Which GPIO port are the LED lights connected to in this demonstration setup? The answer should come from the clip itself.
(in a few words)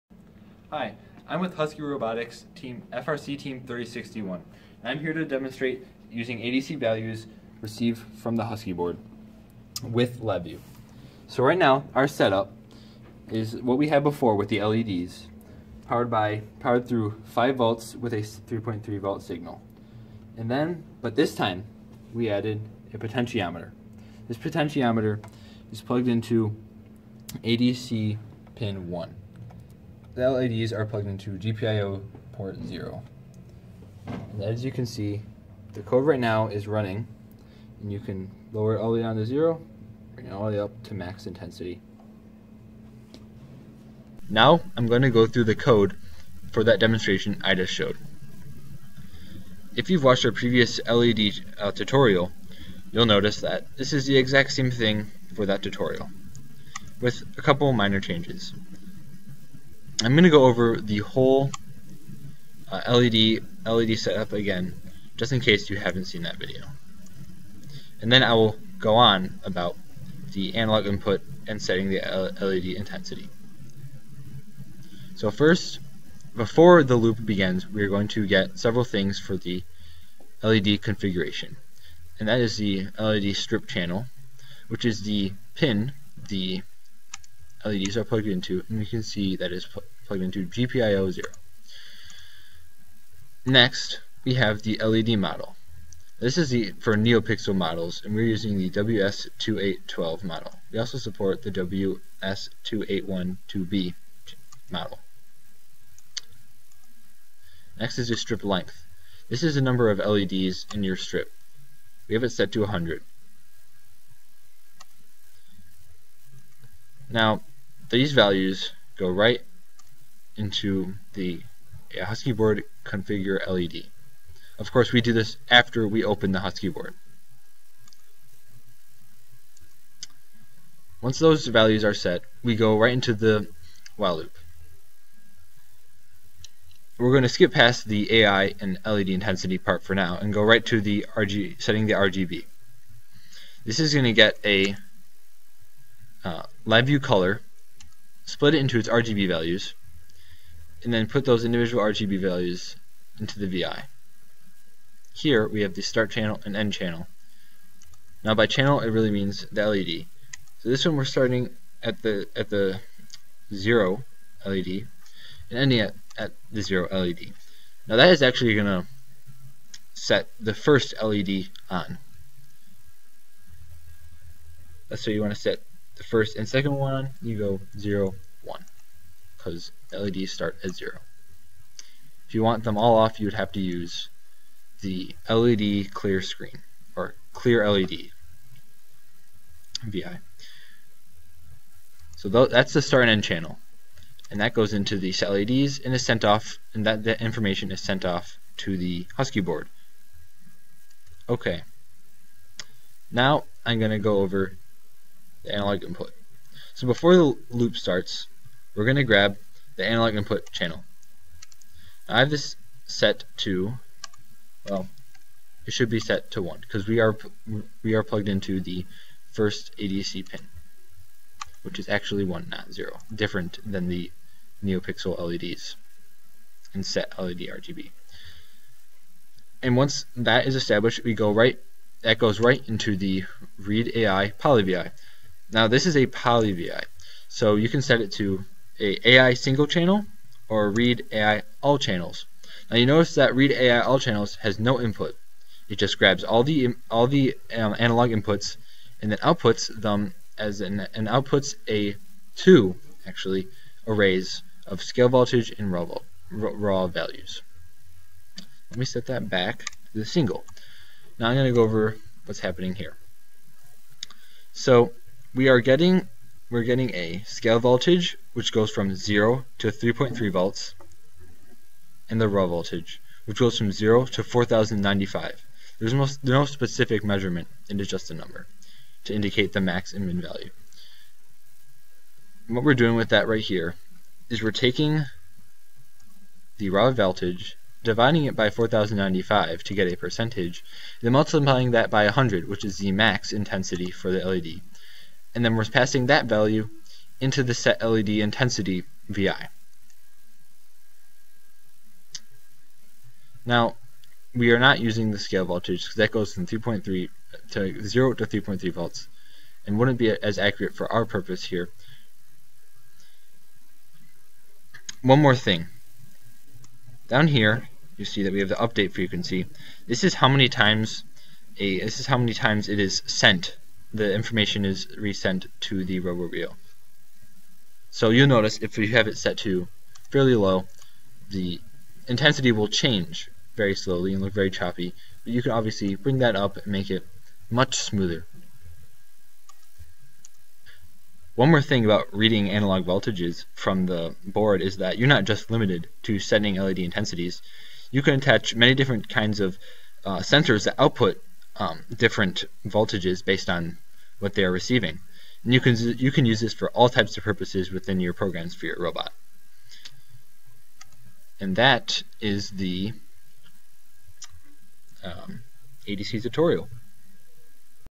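0.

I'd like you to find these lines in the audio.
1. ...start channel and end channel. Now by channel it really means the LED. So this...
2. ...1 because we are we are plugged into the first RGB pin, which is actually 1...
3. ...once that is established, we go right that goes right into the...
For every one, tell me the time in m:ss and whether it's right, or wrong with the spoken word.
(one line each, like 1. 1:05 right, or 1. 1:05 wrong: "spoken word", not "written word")
1. 2:35 right
2. 3:36 wrong: "ADC", not "RGB"
3. 3:49 right.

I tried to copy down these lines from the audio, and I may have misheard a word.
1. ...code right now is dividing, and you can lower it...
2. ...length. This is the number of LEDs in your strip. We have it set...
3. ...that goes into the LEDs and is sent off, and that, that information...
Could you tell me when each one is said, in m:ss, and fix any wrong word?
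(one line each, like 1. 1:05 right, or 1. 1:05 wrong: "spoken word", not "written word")
1. 0:35 wrong: "running", not "dividing"
2. 1:48 right
3. 3:14 right.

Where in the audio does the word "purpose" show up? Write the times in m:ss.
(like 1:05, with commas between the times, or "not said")
5:11, 5:57.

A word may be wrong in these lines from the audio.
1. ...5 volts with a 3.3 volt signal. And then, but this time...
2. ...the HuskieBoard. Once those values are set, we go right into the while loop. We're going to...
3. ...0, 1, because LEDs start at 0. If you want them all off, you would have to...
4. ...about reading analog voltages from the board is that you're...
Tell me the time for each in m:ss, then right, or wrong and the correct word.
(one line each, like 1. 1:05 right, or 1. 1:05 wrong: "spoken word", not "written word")
1. 0:17 right
2. 2:06 right
3. 2:57 right
4. 5:41 right.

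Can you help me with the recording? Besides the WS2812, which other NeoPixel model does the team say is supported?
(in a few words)
WS2812B.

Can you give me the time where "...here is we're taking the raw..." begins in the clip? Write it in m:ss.
4:43.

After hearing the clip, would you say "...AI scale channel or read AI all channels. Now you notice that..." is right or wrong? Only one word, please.
wrong.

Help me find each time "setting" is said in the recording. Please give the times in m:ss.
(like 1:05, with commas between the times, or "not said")
1:11, 2:21, 5:46.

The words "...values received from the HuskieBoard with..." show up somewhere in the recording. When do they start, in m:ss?
0:06.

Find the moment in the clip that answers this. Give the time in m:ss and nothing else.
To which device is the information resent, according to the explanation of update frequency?
5:25.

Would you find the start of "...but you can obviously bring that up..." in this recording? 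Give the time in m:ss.
5:35.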